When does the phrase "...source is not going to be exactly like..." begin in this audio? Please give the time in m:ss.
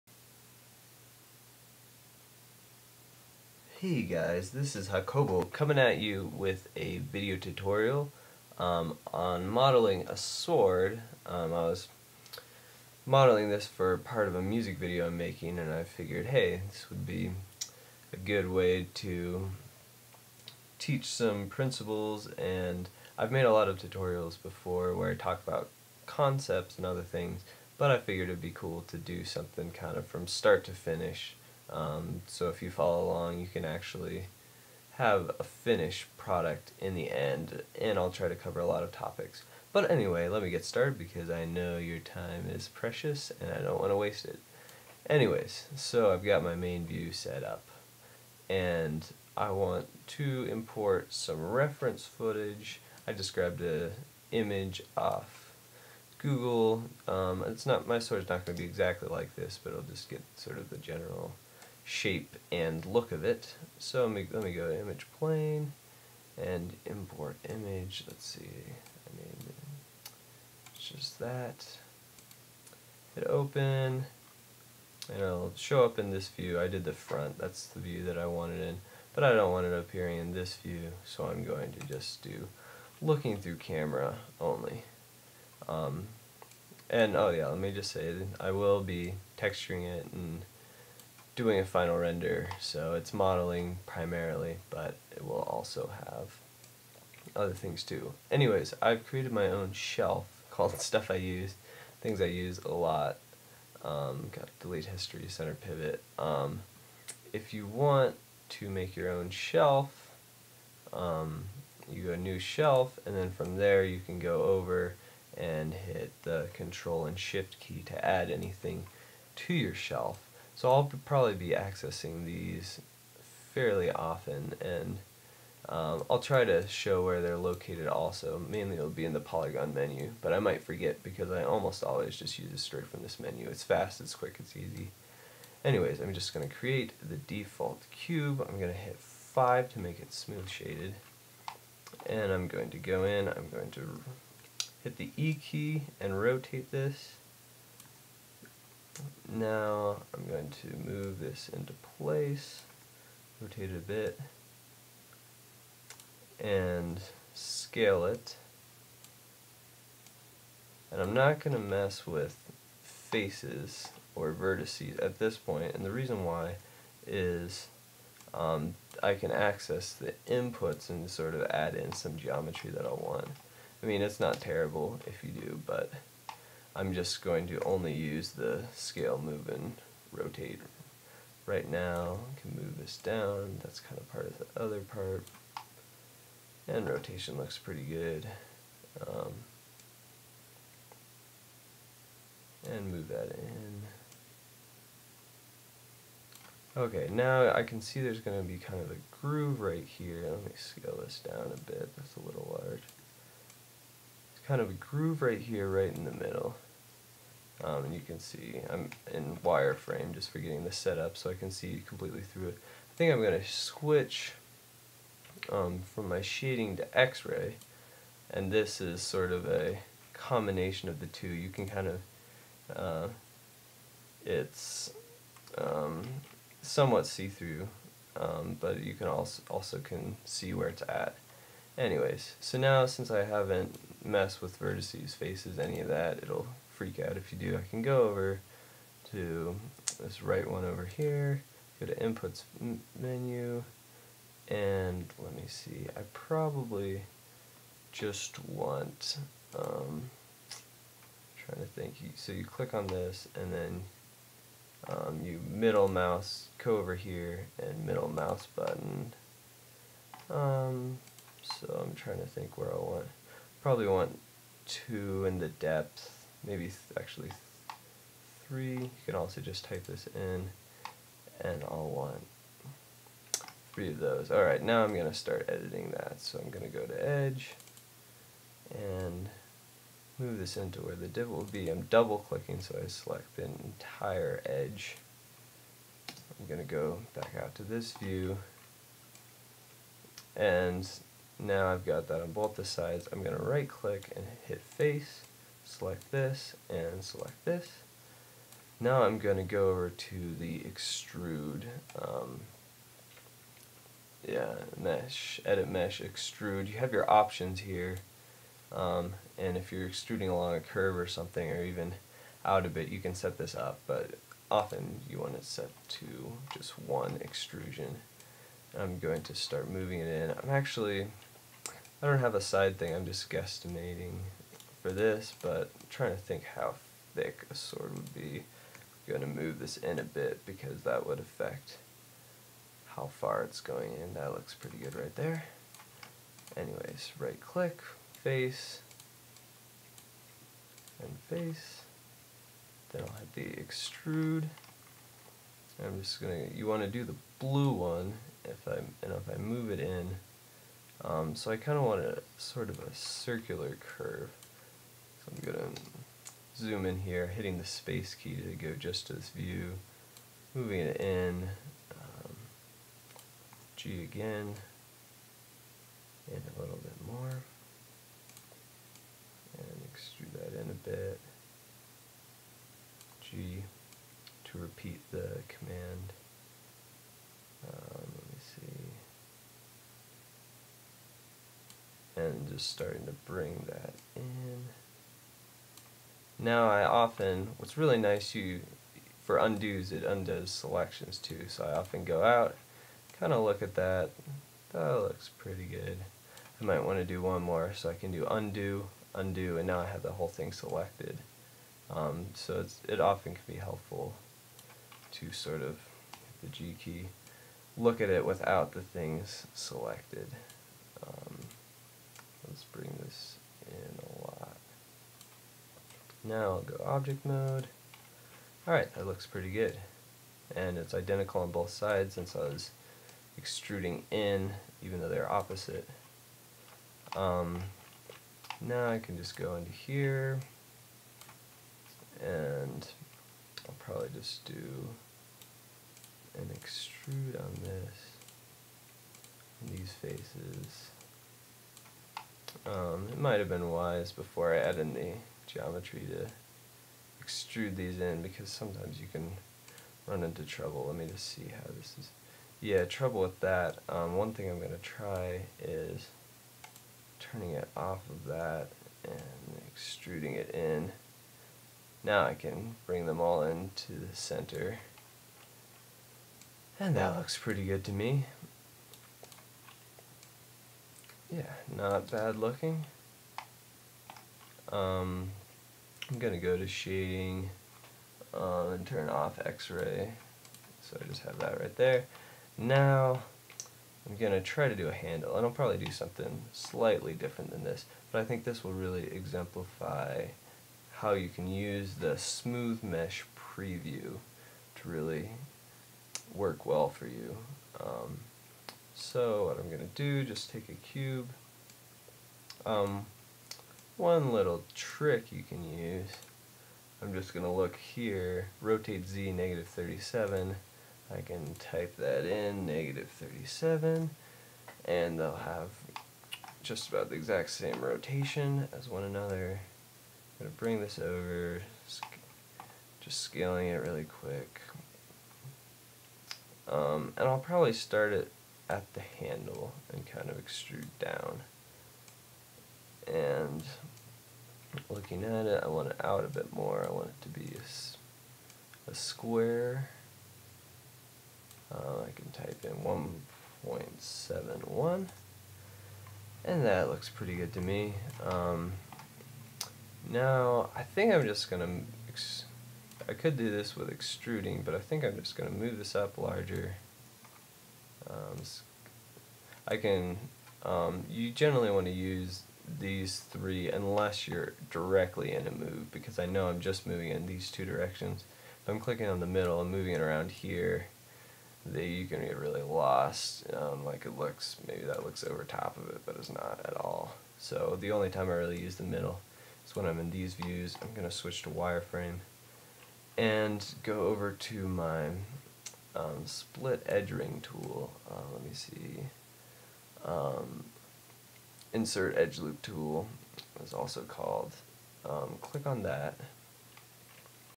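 0:57.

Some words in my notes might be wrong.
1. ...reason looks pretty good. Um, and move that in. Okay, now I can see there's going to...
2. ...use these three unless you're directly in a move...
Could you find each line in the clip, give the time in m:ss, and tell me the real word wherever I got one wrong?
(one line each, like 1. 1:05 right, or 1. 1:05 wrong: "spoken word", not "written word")
1. 3:06 wrong: "rotation", not "reason"
2. 9:21 right.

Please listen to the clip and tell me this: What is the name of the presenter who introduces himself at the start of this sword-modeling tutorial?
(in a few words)
Hacobo.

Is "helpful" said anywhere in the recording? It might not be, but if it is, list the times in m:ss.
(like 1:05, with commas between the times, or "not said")
6:43.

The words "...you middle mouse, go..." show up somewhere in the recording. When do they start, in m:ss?
4:15.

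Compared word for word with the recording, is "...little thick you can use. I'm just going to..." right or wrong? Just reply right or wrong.
wrong.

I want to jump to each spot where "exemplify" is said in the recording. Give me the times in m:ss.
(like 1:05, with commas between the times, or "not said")
8:09.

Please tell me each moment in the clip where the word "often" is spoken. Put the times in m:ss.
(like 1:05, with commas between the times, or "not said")
2:03, 5:14, 6:26, 6:31, 6:42.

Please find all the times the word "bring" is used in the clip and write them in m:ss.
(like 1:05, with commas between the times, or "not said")
6:23, 7:42, 8:40.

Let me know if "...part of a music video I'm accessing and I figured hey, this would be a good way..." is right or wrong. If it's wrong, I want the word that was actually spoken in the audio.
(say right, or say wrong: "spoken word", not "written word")
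wrong: "making", not "accessing".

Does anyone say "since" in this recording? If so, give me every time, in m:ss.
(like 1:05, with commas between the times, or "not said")
3:52, 7:02.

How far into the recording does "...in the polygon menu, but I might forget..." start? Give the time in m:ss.
2:09.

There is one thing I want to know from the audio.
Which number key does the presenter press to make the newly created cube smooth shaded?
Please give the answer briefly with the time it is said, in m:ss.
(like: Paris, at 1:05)
5, at 2:18.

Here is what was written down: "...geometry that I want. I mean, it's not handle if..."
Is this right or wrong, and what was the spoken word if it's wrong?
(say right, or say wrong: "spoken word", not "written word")
wrong: "terrible", not "handle".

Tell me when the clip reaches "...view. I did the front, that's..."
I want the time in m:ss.
1:16.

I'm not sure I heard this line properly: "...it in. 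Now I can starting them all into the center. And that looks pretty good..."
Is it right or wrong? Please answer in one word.
wrong.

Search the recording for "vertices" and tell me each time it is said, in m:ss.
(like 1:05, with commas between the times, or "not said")
2:44, 3:54.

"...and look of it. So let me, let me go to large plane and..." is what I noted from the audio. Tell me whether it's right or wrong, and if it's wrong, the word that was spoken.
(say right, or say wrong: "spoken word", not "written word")
wrong: "image", not "large".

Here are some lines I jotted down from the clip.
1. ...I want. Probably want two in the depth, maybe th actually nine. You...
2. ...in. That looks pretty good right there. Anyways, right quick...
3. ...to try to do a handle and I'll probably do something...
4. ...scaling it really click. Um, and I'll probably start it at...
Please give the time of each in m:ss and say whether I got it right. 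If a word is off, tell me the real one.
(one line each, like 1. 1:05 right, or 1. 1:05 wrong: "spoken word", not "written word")
1. 4:22 wrong: "three", not "nine"
2. 5:33 wrong: "click", not "quick"
3. 8:04 right
4. 8:43 wrong: "quick", not "click".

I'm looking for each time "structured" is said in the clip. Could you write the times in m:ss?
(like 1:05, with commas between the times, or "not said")
not said.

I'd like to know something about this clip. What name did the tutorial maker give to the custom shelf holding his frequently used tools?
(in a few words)
Stuff I Use.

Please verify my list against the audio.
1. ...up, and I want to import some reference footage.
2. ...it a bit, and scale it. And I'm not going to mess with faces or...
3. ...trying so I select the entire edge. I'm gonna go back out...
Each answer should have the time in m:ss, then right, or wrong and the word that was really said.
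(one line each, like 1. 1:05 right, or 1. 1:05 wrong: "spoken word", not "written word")
1. 0:47 right
2. 2:33 right
3. 4:42 wrong: "clicking", not "trying".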